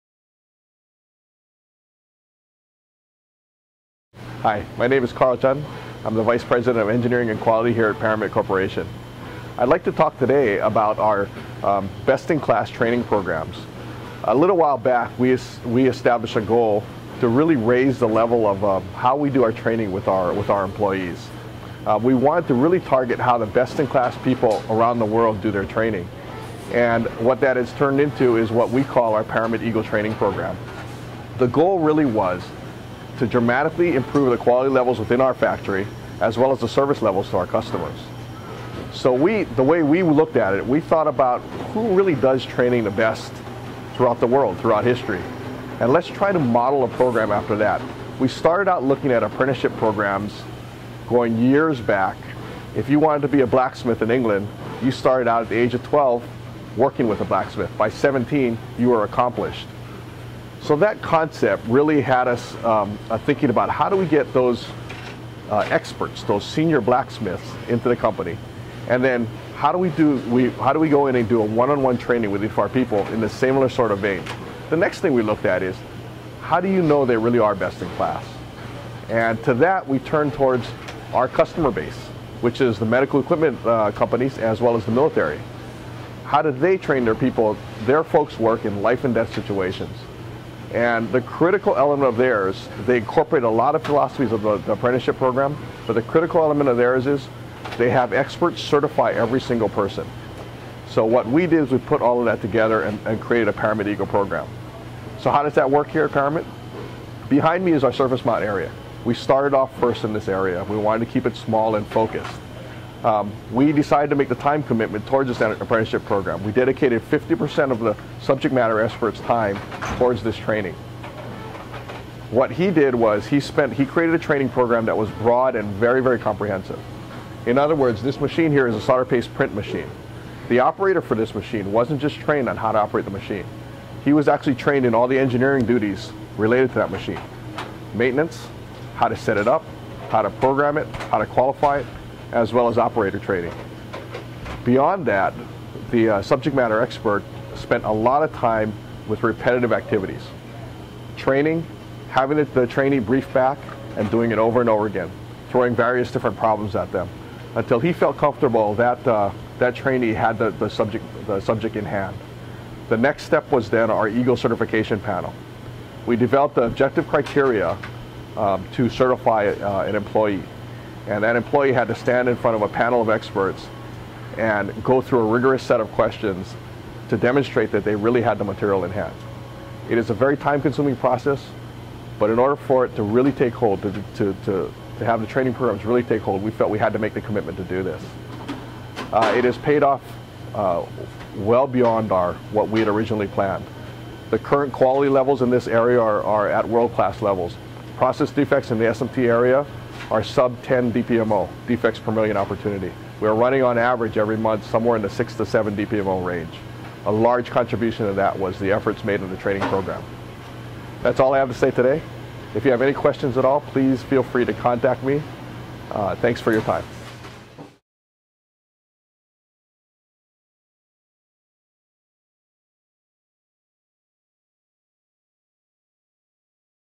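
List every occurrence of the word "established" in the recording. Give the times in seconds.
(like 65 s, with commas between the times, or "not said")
15 s.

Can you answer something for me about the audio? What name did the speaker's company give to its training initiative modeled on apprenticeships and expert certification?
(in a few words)
Paramit Eagle Training Program.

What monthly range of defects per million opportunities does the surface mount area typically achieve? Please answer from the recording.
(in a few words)
6 to 7 DPMO.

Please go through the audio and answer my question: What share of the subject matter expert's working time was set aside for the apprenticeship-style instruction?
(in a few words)
50%.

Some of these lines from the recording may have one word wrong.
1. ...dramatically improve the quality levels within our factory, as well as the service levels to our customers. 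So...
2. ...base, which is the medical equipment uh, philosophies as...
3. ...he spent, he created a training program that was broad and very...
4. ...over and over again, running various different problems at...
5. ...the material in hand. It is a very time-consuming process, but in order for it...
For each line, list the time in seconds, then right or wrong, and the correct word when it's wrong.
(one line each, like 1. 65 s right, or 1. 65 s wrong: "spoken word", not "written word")
1. 33 s right
2. 81 s wrong: "companies", not "philosophies"
3. 123 s right
4. 154 s wrong: "throwing", not "running"
5. 178 s right.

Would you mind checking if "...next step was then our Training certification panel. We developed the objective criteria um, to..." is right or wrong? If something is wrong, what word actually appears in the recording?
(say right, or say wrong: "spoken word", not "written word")
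wrong: "Eagle", not "Training".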